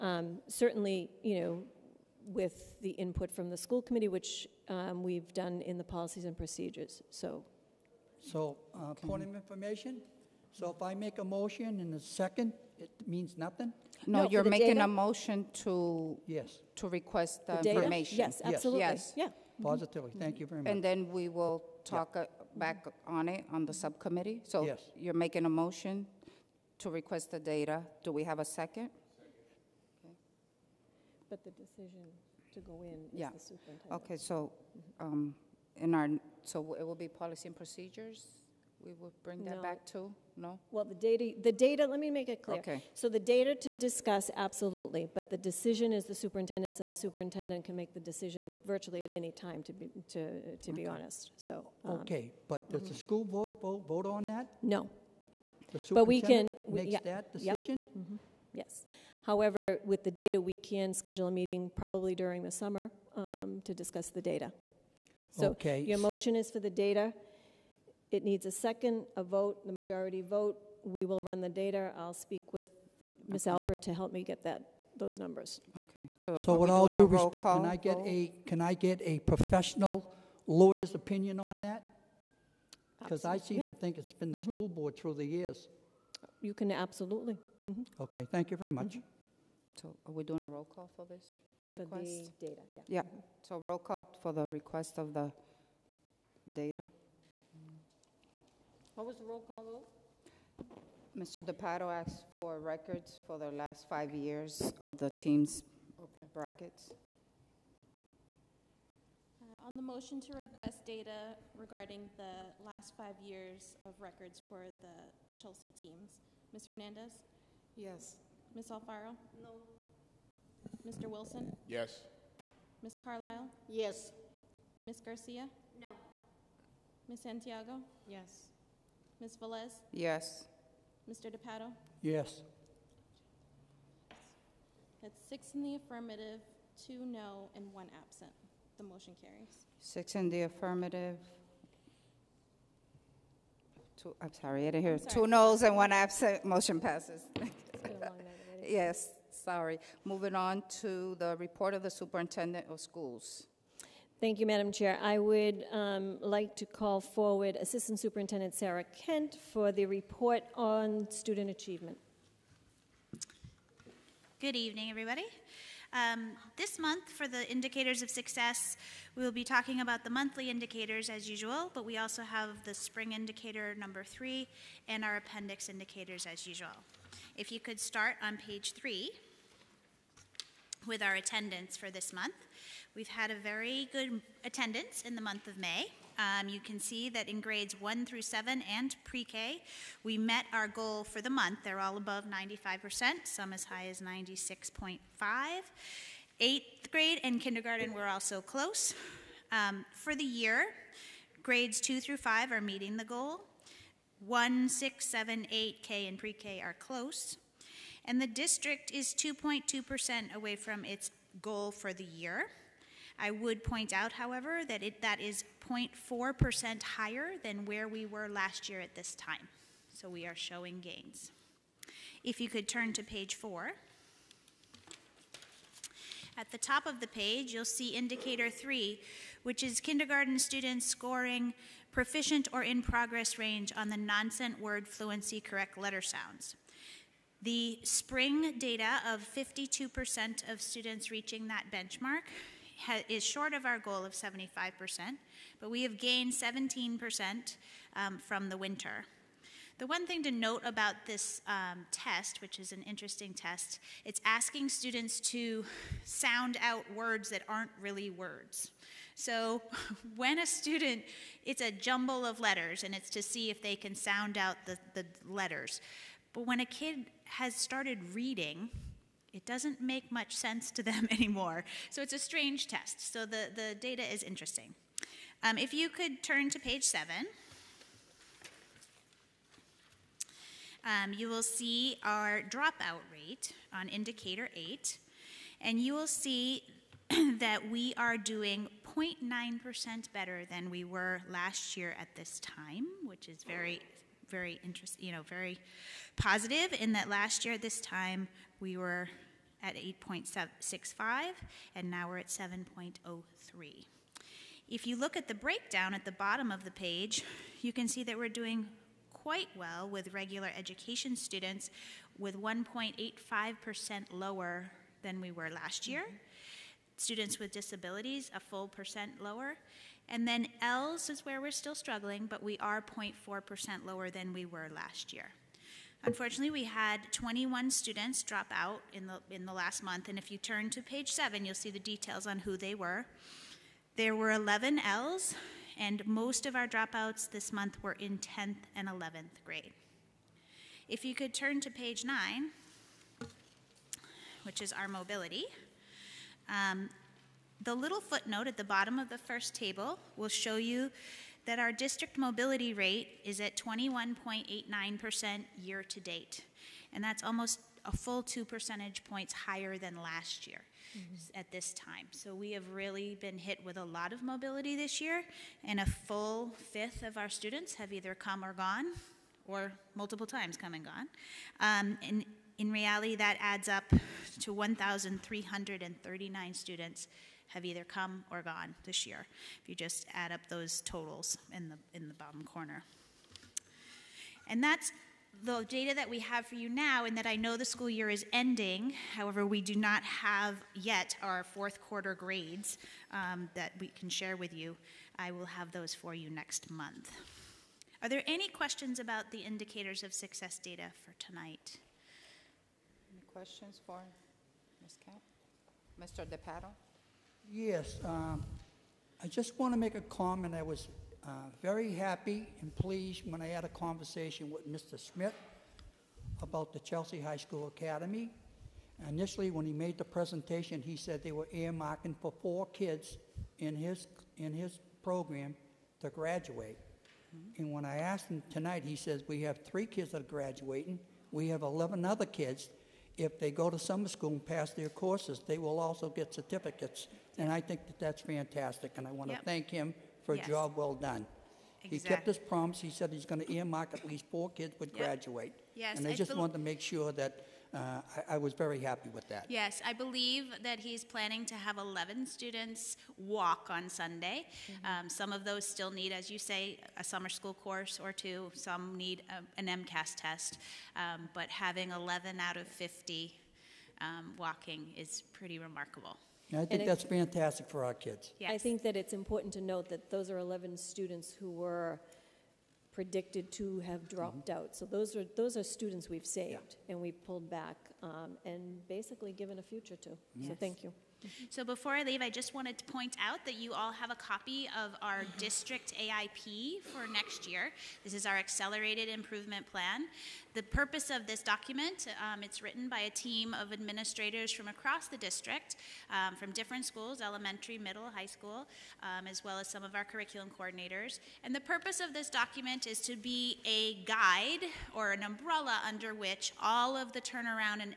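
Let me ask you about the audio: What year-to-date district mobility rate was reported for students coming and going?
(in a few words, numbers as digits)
21.89%.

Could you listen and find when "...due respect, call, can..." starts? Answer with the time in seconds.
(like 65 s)
76 s.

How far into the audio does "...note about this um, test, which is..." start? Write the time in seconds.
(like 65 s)
250 s.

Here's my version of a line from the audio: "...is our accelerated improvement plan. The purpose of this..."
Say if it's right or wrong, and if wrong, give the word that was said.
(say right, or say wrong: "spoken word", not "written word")
right.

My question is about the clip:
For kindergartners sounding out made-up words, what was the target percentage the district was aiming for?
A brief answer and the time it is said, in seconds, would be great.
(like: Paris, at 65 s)
75%, at 244 s.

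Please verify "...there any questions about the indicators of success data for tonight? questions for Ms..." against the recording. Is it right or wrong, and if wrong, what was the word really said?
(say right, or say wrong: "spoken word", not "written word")
right.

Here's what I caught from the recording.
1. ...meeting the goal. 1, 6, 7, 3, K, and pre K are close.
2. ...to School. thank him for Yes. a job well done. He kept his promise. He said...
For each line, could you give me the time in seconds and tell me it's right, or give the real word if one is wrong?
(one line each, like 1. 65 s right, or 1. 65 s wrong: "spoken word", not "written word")
1. 202 s wrong: "8", not "3"
2. 439 s wrong: "Yep", not "School".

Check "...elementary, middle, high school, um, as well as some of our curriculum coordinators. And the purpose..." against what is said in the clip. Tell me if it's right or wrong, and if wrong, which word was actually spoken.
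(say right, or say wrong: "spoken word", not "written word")
right.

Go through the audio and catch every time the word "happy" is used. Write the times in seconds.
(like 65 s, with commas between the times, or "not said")
411 s, 448 s.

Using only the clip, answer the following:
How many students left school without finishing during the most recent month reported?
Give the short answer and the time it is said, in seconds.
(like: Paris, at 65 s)
21, at 327 s.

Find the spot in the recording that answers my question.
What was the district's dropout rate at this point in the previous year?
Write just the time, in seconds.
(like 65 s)
299 s.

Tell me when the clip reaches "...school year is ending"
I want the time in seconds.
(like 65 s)
387 s.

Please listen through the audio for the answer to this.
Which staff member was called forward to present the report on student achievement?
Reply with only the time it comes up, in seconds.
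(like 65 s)
158 s.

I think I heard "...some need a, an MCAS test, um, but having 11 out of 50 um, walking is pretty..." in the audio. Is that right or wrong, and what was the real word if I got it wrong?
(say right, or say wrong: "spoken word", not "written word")
right.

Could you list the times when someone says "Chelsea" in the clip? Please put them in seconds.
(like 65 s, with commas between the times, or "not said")
115 s, 416 s.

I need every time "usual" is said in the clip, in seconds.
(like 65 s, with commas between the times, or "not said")
171 s, 176 s.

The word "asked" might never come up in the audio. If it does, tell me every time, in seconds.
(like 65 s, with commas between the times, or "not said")
101 s, 427 s.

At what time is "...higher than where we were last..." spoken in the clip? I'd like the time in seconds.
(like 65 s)
216 s.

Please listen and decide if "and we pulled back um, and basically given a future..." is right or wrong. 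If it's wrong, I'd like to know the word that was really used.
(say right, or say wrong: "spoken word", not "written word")
right.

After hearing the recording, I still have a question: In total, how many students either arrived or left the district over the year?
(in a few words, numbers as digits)
1,339.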